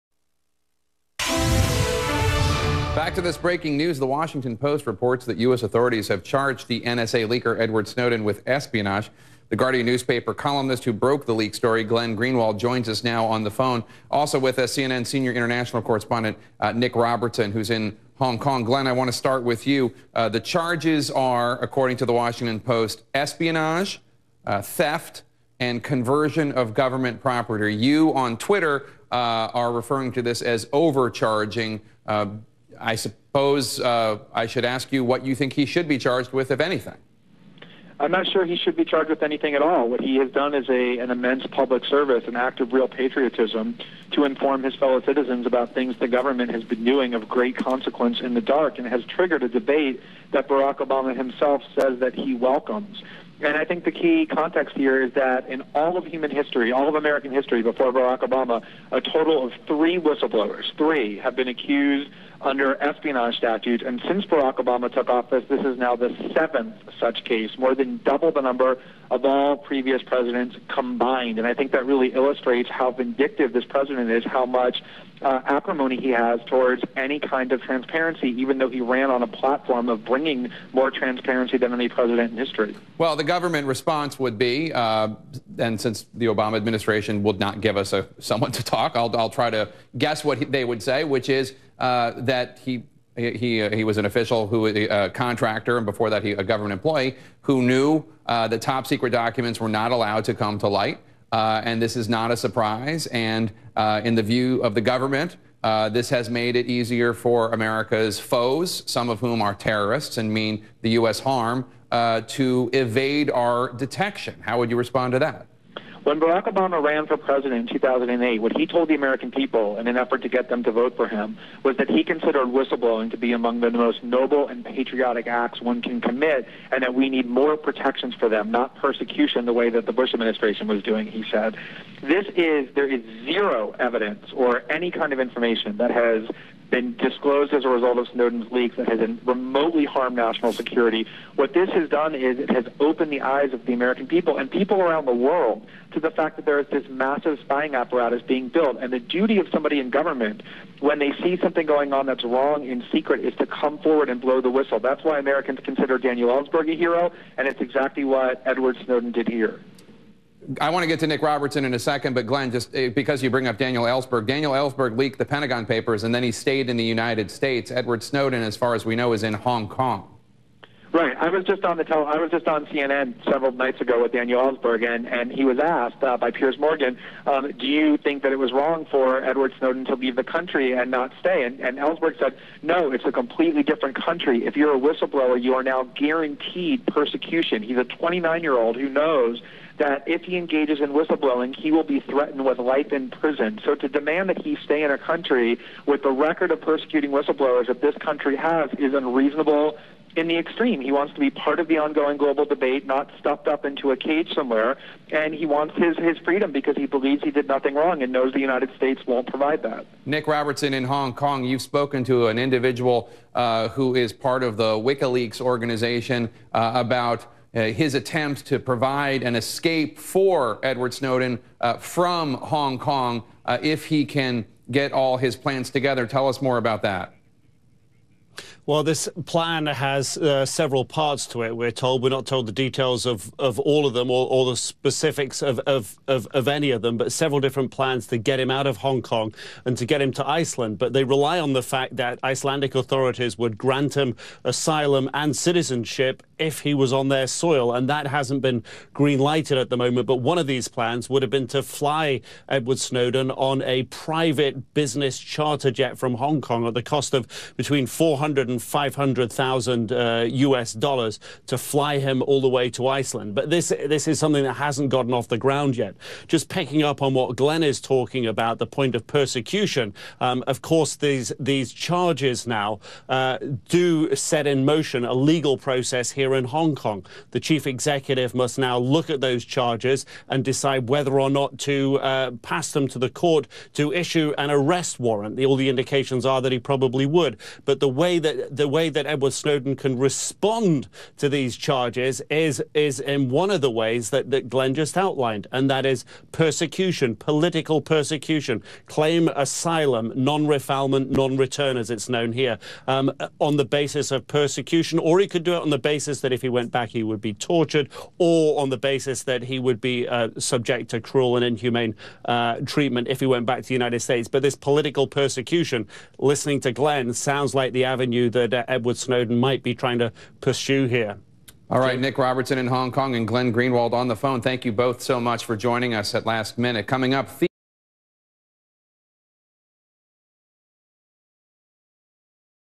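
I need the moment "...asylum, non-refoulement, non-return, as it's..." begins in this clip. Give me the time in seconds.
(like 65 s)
299 s.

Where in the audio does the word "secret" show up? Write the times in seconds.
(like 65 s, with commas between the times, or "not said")
98 s, 152 s.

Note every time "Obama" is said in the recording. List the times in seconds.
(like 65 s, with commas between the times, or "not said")
50 s, 58 s, 64 s, 86 s, 116 s.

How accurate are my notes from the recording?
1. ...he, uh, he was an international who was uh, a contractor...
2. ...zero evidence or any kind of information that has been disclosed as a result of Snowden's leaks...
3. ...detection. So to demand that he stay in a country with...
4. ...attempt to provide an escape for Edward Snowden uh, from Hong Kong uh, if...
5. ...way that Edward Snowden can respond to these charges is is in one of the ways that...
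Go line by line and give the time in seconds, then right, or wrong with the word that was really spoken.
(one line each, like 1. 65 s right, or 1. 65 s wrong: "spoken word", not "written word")
1. 93 s wrong: "official", not "international"
2. 133 s right
3. 193 s wrong: "prison", not "detection"
4. 217 s right
5. 288 s right.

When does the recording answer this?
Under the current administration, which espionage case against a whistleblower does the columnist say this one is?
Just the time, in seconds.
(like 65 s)
66 s.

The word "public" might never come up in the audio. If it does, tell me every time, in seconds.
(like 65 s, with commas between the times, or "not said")
41 s.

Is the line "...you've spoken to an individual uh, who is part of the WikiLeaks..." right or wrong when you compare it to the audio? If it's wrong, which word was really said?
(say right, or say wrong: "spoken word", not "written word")
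right.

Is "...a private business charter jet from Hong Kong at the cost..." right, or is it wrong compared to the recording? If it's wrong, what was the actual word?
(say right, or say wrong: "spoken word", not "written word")
right.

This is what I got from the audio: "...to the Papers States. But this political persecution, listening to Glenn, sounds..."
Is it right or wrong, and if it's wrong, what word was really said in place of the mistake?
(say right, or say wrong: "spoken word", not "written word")
wrong: "United", not "Papers".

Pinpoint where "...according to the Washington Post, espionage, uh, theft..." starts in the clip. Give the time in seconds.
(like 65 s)
21 s.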